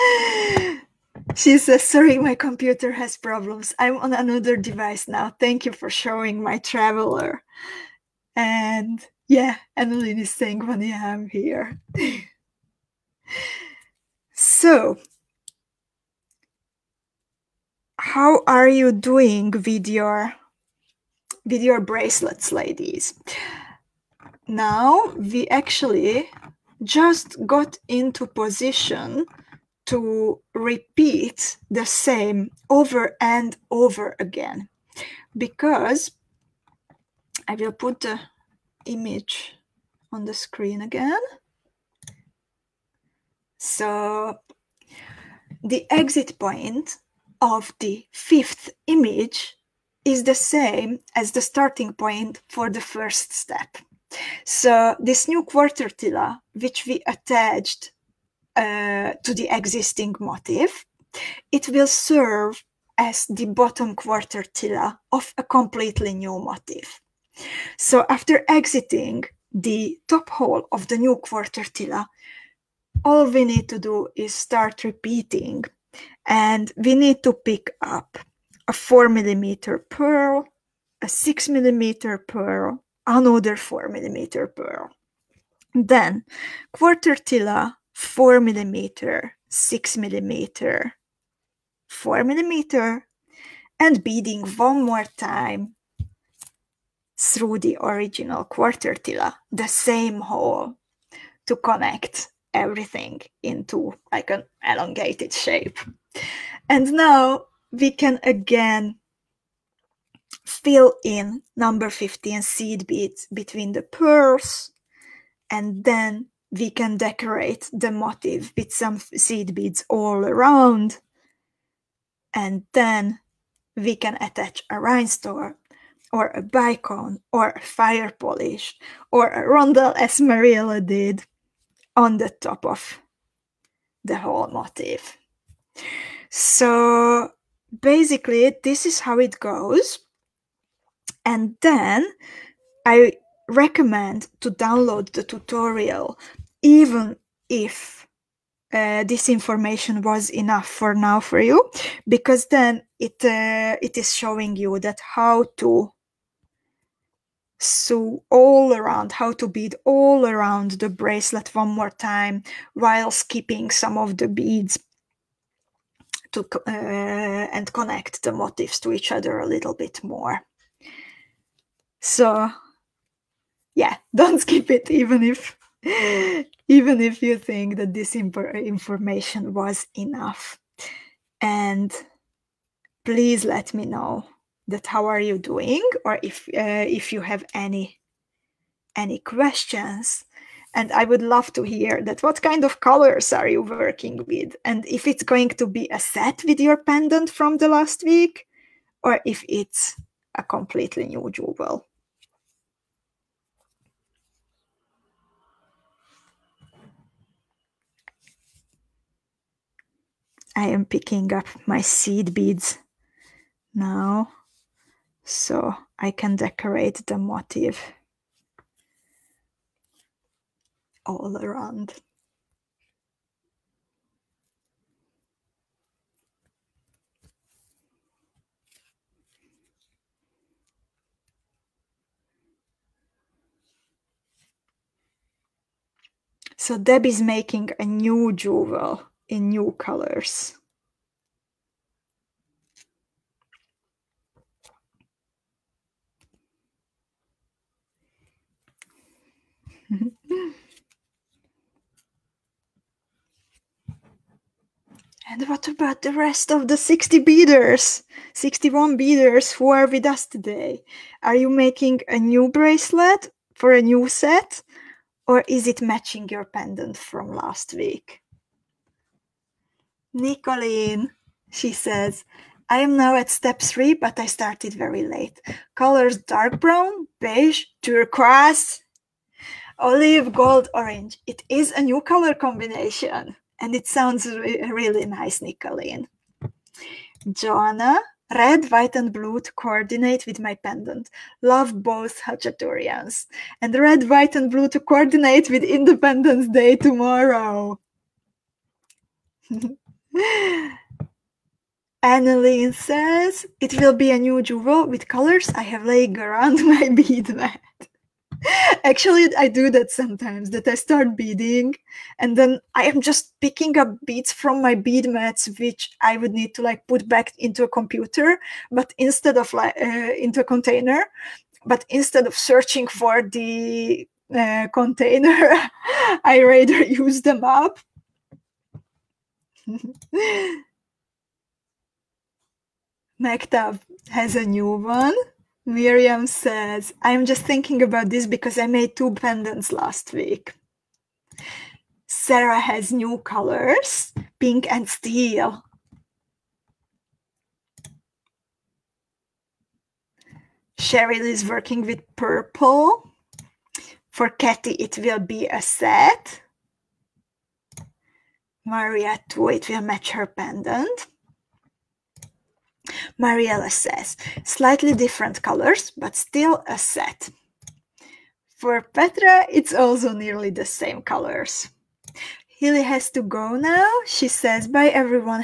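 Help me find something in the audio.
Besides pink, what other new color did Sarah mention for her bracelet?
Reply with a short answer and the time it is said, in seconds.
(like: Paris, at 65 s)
steel, at 344 s.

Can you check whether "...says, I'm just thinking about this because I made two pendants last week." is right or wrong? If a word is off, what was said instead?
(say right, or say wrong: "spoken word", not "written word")
right.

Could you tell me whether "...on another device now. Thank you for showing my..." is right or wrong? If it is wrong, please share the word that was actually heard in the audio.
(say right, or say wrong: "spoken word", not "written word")
right.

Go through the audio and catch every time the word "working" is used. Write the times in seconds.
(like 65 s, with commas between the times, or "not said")
193 s, 351 s.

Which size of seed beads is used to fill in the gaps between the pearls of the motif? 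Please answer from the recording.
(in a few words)
15.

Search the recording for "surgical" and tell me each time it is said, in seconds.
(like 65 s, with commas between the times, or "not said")
not said.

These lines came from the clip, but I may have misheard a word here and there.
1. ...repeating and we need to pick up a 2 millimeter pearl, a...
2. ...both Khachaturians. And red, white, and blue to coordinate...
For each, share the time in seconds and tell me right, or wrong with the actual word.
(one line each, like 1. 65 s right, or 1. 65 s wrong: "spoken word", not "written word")
1. 74 s wrong: "4", not "2"
2. 291 s right.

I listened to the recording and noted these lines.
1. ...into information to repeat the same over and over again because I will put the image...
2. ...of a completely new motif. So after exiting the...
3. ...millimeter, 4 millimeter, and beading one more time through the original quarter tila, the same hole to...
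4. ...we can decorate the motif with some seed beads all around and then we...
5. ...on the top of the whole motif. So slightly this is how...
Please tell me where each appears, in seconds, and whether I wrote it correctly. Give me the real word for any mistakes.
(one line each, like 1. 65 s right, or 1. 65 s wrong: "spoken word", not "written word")
1. 27 s wrong: "position", not "information"
2. 65 s right
3. 89 s right
4. 116 s right
5. 131 s wrong: "basically", not "slightly".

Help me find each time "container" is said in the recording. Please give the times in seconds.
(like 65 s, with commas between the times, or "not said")
320 s, 324 s.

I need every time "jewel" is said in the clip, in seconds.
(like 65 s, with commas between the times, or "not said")
201 s, 238 s, 304 s.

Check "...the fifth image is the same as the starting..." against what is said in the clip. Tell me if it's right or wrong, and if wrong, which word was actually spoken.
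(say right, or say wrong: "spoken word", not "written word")
right.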